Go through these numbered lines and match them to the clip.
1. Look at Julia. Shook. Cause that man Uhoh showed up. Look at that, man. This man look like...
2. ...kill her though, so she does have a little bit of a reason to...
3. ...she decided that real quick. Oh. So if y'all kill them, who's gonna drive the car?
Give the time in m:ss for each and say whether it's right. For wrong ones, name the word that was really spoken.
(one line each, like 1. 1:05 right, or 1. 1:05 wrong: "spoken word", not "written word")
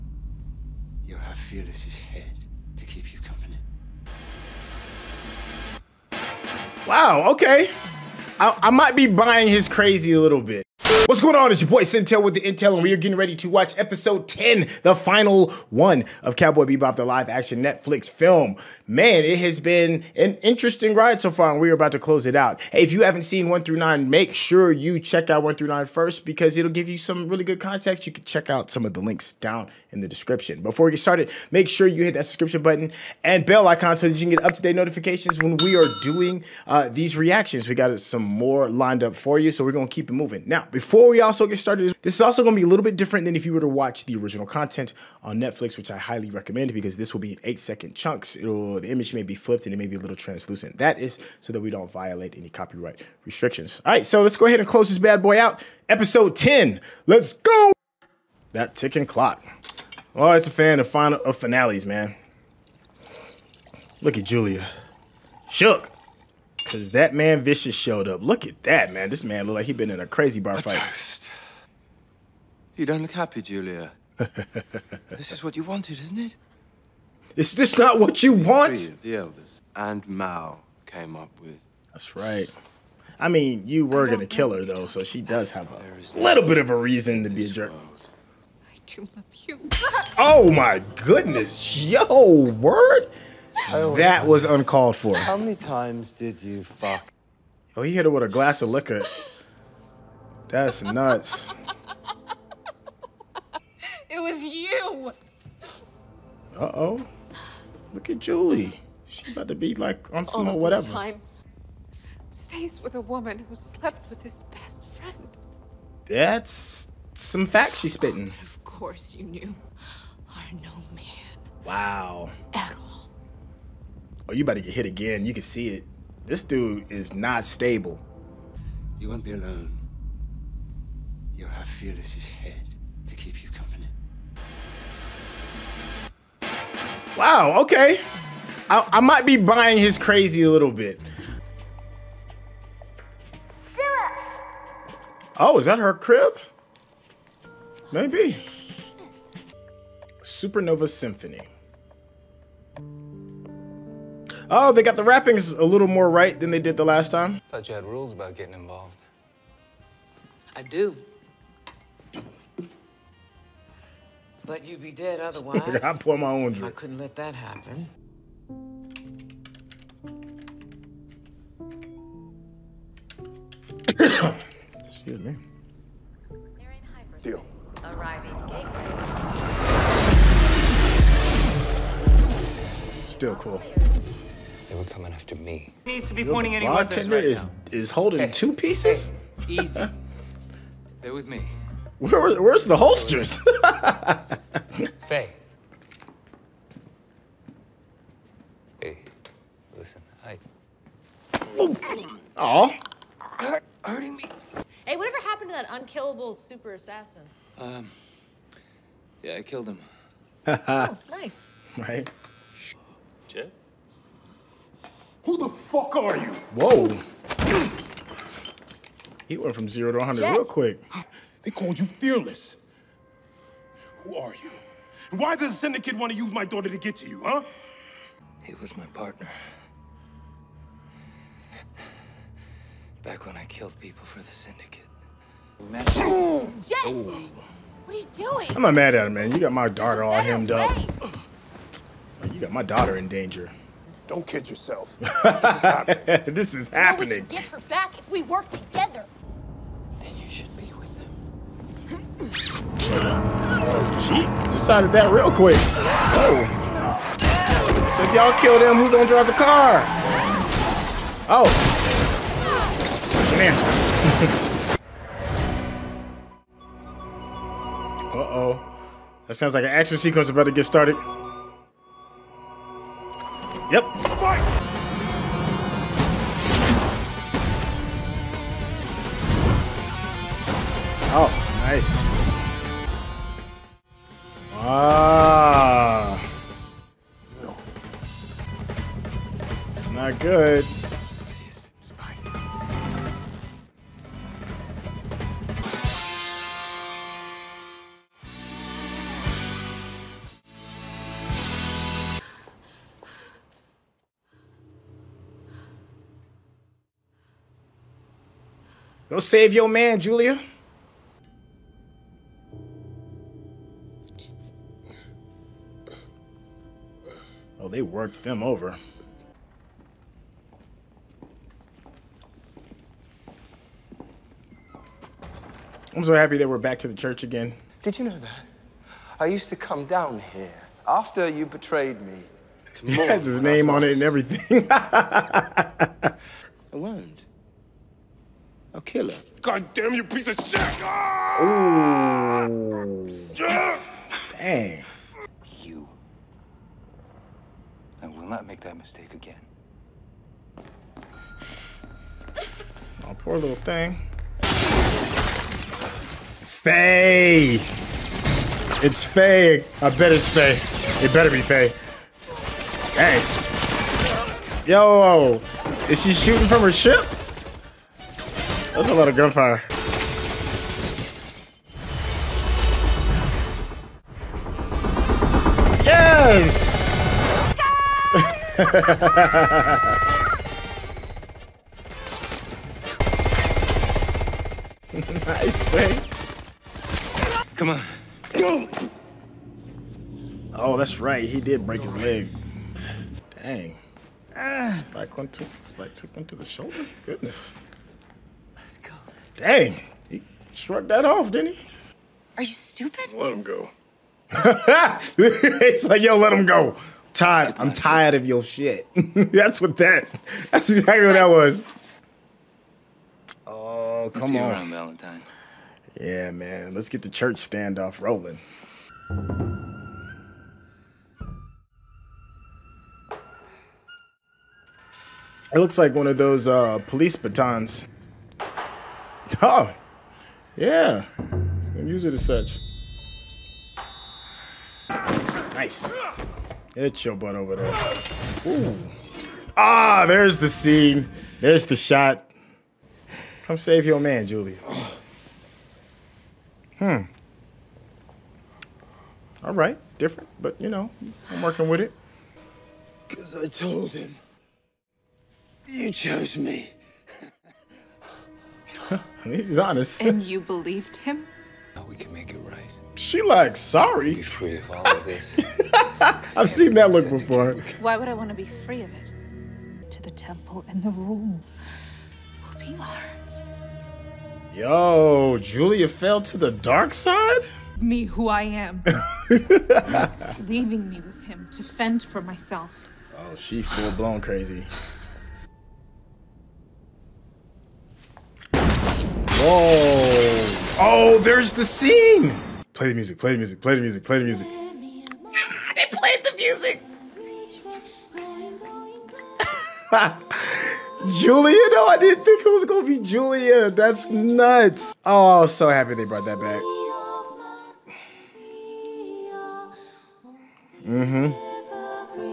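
1. 1:03 wrong: "Vicious", not "Uhoh"
2. 1:24 right
3. 4:14 right.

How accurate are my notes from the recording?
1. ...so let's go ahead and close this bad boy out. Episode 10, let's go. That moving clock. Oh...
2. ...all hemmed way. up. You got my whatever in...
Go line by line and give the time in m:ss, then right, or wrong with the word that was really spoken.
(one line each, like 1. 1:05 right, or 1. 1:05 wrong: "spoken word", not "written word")
1. 0:54 wrong: "ticking", not "moving"
2. 4:00 wrong: "daughter", not "whatever".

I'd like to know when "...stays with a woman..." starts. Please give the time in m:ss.
1:52.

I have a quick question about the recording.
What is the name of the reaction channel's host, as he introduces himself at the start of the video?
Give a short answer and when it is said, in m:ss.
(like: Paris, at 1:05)
Syntell, at 0:11.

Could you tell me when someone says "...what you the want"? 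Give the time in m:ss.
1:17.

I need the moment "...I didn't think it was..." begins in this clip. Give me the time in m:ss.
8:21.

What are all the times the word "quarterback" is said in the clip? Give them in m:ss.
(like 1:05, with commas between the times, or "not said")
not said.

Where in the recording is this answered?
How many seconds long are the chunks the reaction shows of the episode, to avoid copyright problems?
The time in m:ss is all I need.
0:47.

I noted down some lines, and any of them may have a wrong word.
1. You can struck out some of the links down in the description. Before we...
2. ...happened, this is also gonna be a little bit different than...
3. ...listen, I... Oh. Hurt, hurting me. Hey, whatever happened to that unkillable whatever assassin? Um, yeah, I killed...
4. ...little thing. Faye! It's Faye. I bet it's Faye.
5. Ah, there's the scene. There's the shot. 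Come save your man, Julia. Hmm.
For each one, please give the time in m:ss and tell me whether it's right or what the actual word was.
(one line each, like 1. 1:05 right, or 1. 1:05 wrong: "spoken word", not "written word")
1. 0:28 wrong: "check", not "struck"
2. 0:41 wrong: "started", not "happened"
3. 3:19 wrong: "super", not "whatever"
4. 5:53 right
5. 7:19 right.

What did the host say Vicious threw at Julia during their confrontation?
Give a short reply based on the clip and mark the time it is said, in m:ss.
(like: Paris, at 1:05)
A glass of liquor, at 1:38.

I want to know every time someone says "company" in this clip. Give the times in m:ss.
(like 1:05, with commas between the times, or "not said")
0:03, 2:13.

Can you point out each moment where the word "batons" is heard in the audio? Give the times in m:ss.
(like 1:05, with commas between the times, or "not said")
7:07.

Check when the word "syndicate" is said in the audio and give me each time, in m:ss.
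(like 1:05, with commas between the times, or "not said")
3:45, 3:54.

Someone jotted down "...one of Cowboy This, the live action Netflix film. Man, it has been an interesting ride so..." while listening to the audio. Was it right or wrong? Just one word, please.
wrong.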